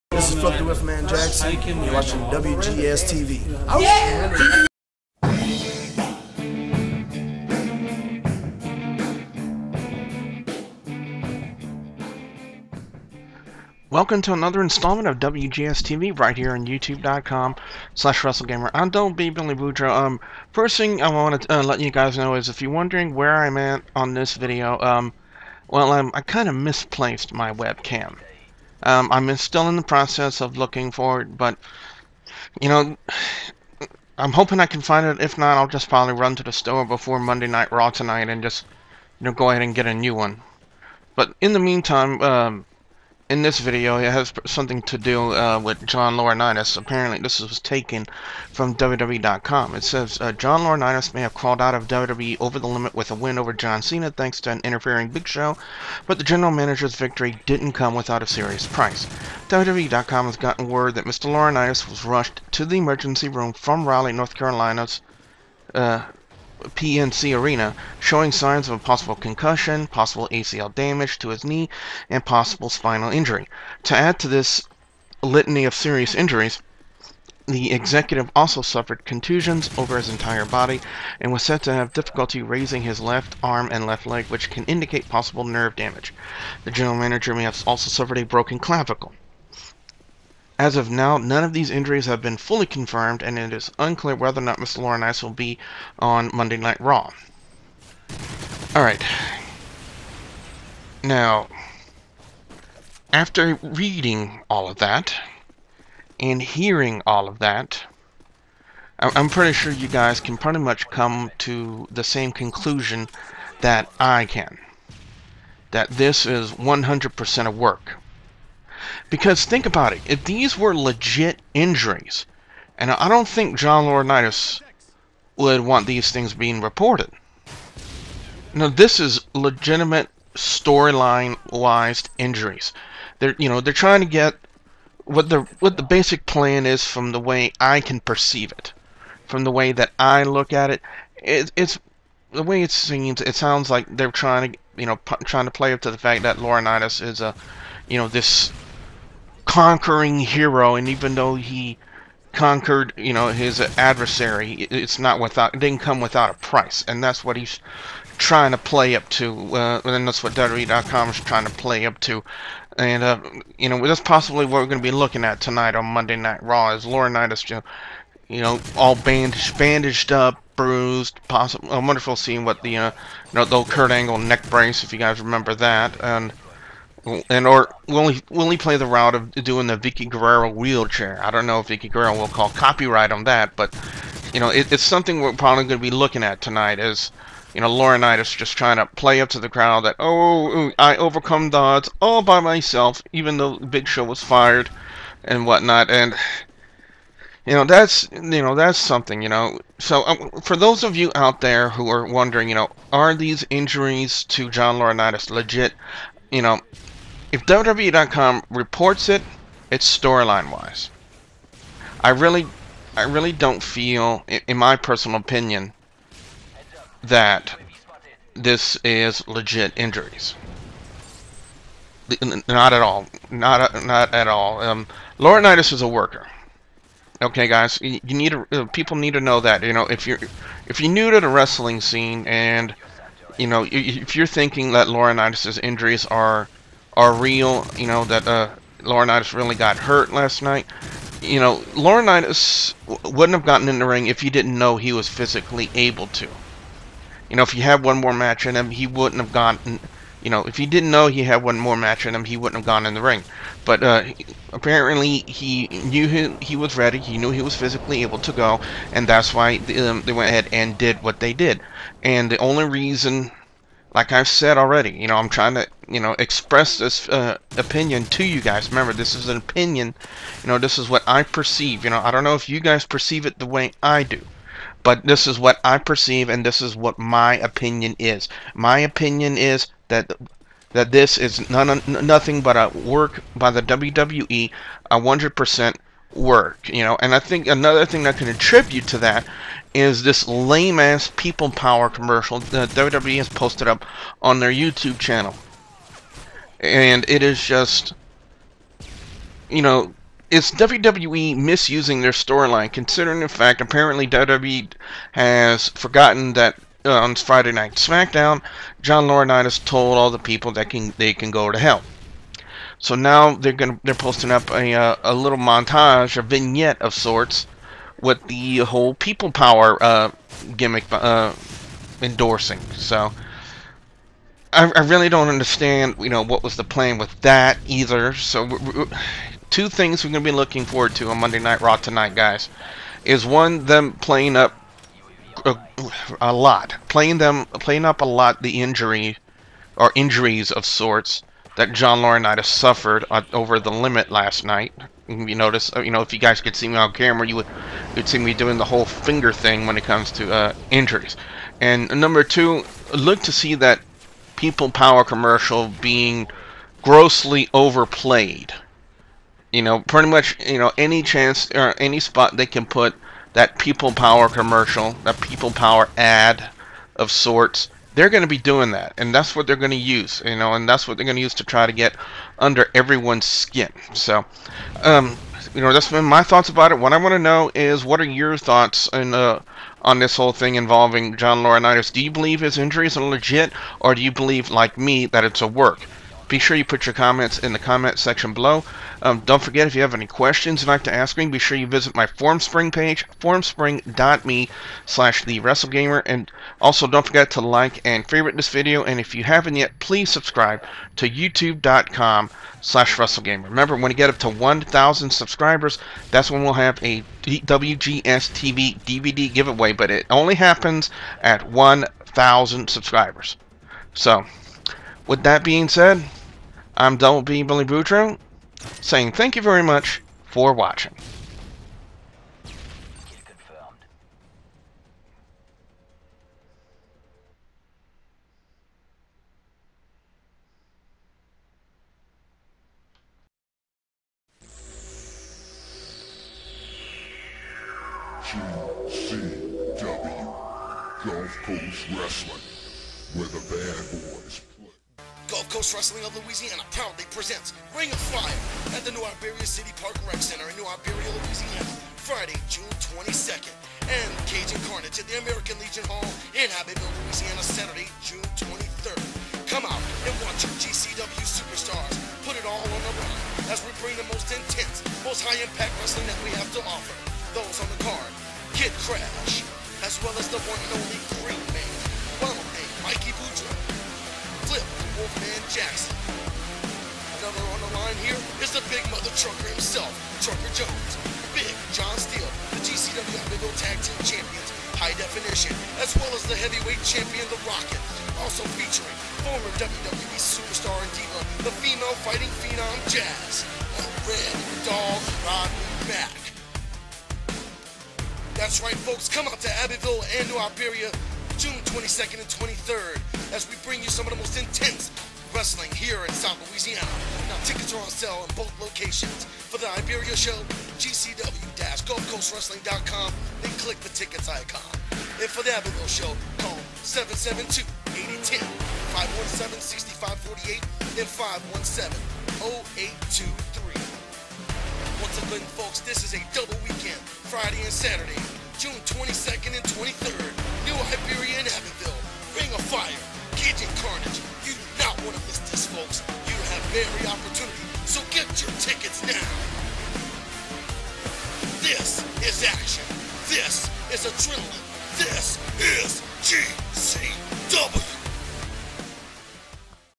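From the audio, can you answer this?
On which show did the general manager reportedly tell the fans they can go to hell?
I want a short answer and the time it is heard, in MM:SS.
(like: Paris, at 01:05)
Friday Night SmackDown, at 05:07.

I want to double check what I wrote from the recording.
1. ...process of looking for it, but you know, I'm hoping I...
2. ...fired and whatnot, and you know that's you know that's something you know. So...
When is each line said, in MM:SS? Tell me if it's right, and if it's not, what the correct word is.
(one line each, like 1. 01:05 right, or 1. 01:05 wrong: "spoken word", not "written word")
1. 00:29 right
2. 03:14 right.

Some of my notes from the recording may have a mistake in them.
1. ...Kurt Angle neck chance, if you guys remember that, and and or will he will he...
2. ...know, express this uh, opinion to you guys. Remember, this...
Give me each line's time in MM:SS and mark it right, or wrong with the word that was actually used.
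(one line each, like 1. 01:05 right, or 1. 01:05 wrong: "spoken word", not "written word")
1. 02:53 wrong: "brace", not "chance"
2. 04:25 right.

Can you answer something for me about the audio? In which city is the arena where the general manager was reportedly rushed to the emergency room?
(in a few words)
Raleigh, North Carolina.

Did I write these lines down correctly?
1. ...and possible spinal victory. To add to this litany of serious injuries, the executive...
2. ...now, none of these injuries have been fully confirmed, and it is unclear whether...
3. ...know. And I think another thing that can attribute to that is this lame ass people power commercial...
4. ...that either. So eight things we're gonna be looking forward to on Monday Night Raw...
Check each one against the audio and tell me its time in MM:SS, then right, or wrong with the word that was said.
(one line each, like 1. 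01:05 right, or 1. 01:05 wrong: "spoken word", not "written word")
1. 01:12 wrong: "injury", not "victory"
2. 01:30 right
3. 04:46 right
4. 05:27 wrong: "two", not "eight".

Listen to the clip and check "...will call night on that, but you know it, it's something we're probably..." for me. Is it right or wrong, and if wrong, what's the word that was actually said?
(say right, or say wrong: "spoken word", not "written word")
wrong: "copyright", not "night".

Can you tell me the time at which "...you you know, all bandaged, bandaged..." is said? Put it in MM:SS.
02:47.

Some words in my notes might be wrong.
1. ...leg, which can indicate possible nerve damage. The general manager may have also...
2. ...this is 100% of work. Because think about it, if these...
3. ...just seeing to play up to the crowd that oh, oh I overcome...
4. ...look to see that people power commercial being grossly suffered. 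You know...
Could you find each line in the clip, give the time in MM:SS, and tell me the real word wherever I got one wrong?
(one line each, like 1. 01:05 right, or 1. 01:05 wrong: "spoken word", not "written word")
1. 01:24 right
2. 01:55 right
3. 03:08 wrong: "trying", not "seeing"
4. 05:52 wrong: "overplayed", not "suffered".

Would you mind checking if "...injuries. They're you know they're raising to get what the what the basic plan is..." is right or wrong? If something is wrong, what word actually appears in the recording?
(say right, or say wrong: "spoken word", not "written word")
wrong: "trying", not "raising".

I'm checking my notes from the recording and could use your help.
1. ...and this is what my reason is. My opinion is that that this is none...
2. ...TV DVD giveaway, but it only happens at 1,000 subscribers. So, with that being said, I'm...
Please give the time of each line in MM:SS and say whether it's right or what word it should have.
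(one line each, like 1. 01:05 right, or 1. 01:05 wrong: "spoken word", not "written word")
1. 04:36 wrong: "opinion", not "reason"
2. 06:48 right.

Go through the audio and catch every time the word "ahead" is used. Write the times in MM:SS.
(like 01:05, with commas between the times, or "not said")
00:39, 04:20.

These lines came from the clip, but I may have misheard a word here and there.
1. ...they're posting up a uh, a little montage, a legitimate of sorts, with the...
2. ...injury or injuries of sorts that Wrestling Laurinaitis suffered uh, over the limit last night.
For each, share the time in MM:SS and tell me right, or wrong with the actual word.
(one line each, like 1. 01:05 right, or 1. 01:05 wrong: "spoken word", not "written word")
1. 05:13 wrong: "vignette", not "legitimate"
2. 05:38 wrong: "John", not "Wrestling".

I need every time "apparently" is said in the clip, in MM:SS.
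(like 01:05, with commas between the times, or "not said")
00:46, 04:14, 05:03.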